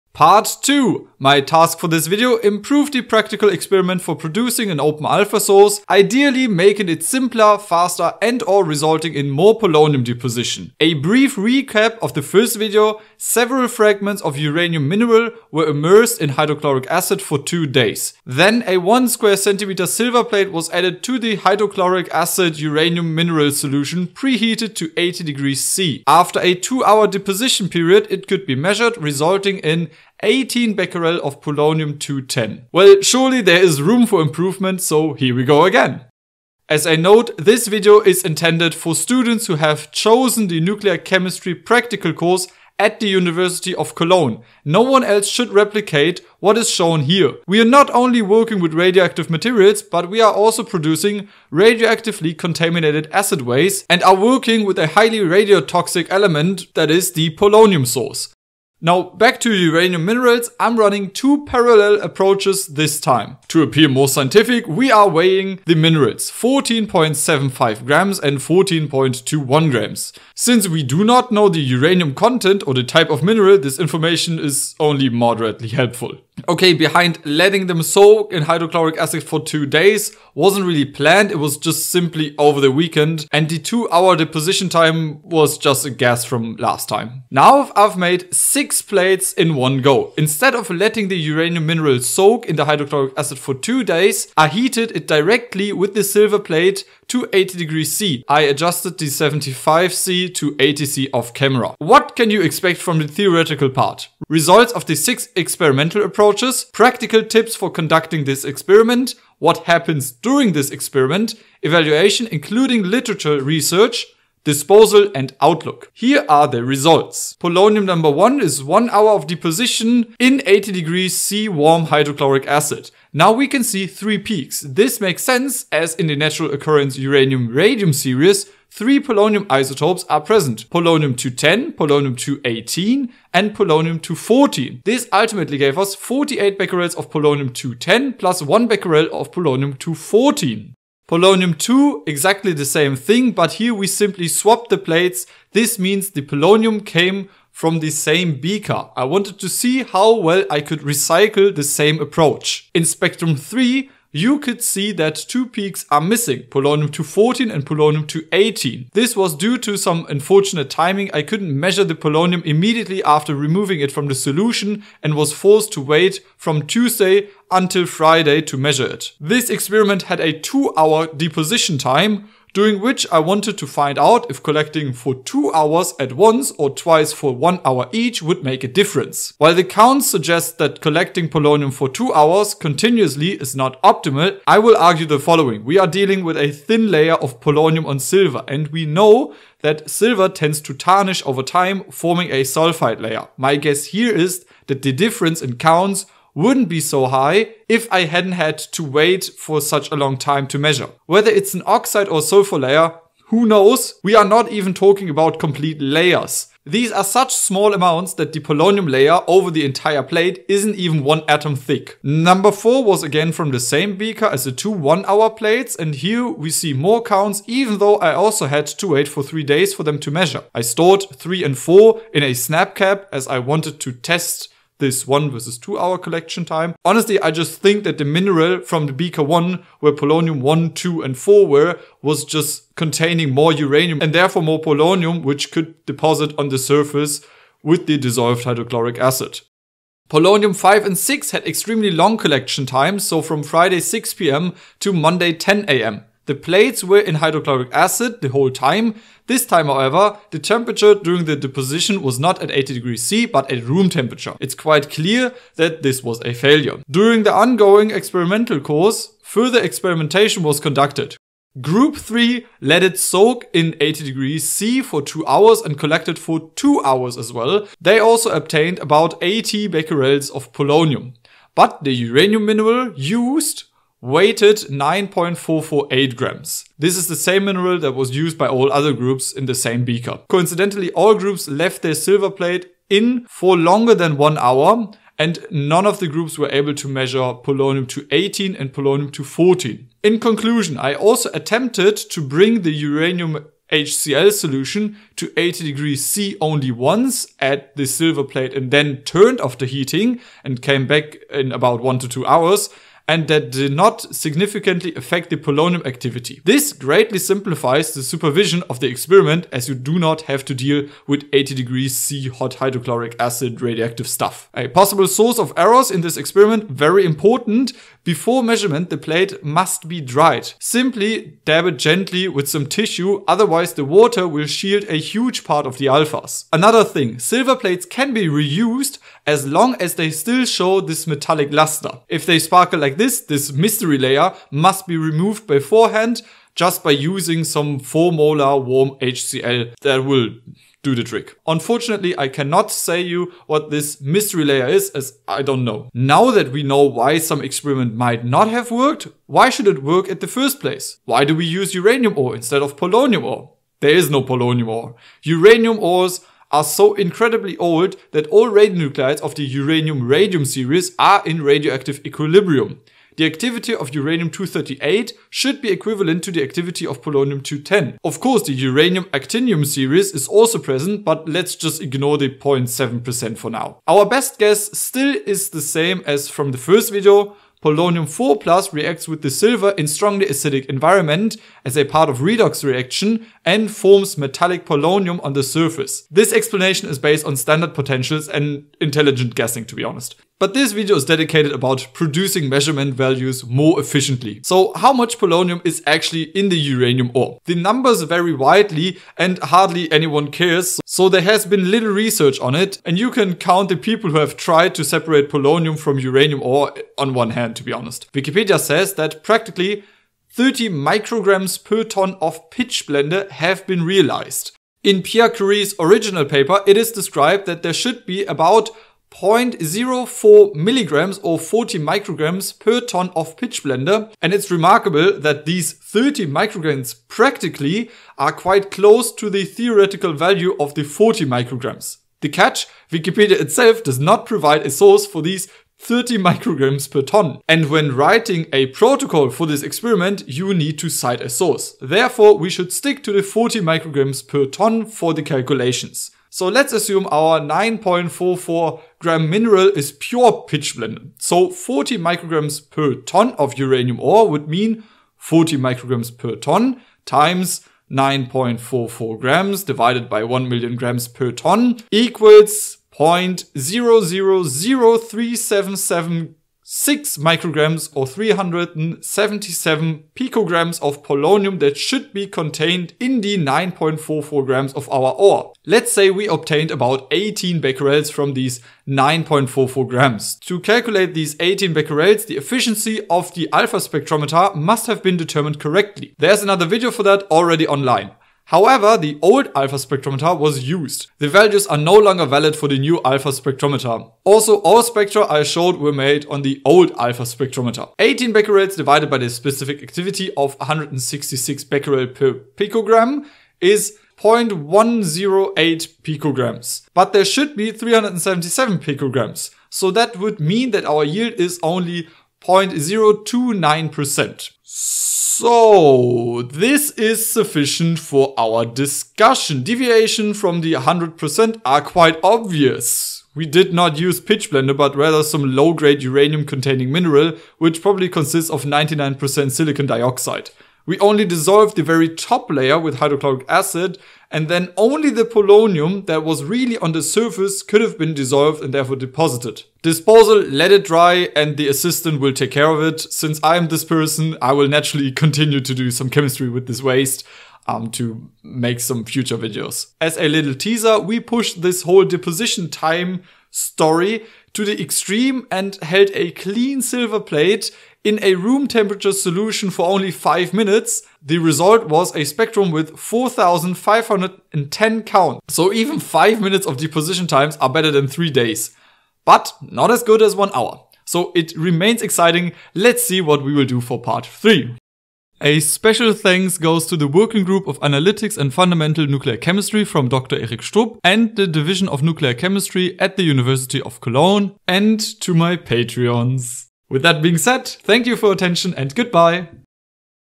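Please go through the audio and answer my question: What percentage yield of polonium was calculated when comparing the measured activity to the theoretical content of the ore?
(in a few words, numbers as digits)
0.029%.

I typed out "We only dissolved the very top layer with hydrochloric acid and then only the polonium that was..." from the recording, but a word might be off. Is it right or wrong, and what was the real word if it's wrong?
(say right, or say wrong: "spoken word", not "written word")
right.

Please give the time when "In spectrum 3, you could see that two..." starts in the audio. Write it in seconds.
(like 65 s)
152 s.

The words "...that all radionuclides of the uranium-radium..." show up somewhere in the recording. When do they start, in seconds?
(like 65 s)
358 s.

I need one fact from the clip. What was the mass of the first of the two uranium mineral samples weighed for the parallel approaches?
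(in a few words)
14.75 grams.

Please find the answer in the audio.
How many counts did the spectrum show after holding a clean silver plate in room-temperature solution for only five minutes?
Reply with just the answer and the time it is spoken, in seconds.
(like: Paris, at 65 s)
4,510, at 562 s.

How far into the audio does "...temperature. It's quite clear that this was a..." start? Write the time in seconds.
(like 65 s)
253 s.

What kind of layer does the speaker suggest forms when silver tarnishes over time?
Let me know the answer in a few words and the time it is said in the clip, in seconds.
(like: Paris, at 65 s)
sulfide layer, at 192 s.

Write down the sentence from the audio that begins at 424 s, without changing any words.
And it's remarkable that these 30 micrograms practically are quite close to the theoretical value of the 40 micrograms.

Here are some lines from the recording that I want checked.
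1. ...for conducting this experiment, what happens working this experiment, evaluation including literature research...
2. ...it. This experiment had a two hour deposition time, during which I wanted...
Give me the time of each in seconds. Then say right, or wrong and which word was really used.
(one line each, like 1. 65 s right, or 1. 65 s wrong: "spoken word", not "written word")
1. 107 s wrong: "during", not "working"
2. 168 s right.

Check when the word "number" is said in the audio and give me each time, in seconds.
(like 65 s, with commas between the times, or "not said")
117 s, 212 s, 397 s.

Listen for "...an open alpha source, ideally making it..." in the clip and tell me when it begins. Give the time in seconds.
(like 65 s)
4 s.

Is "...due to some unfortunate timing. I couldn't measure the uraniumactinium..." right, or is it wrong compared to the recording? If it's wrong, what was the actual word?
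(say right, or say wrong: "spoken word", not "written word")
wrong: "polonium", not "uraniumactinium".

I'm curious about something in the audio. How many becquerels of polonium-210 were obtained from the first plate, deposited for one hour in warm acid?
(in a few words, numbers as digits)
48.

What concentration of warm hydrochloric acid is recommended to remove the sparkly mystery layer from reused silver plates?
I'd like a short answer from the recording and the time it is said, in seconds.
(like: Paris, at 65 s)
4 molar, at 337 s.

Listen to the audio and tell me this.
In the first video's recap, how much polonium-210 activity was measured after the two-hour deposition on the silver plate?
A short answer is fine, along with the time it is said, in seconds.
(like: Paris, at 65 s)
18 becquerel, at 30 s.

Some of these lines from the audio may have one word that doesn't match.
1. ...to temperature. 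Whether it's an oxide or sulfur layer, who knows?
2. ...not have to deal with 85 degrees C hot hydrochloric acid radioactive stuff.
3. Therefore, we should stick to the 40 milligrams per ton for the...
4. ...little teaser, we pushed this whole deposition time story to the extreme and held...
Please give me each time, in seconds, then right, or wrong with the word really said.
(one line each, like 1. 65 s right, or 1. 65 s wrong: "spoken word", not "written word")
1. 200 s wrong: "measure", not "temperature"
2. 309 s wrong: "80", not "85"
3. 441 s wrong: "micrograms", not "milligrams"
4. 550 s right.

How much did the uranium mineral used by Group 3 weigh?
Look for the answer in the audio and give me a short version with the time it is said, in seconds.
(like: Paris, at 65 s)
9.448 grams, at 274 s.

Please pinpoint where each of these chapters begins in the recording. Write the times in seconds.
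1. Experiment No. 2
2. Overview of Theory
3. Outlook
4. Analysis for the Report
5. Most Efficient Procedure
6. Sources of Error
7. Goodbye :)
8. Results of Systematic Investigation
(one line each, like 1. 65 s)
1. 36 s
2. 101 s
3. 549 s
4. 345 s
5. 289 s
6. 314 s
7. 575 s
8. 119 s.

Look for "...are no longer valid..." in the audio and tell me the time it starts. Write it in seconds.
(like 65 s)
491 s.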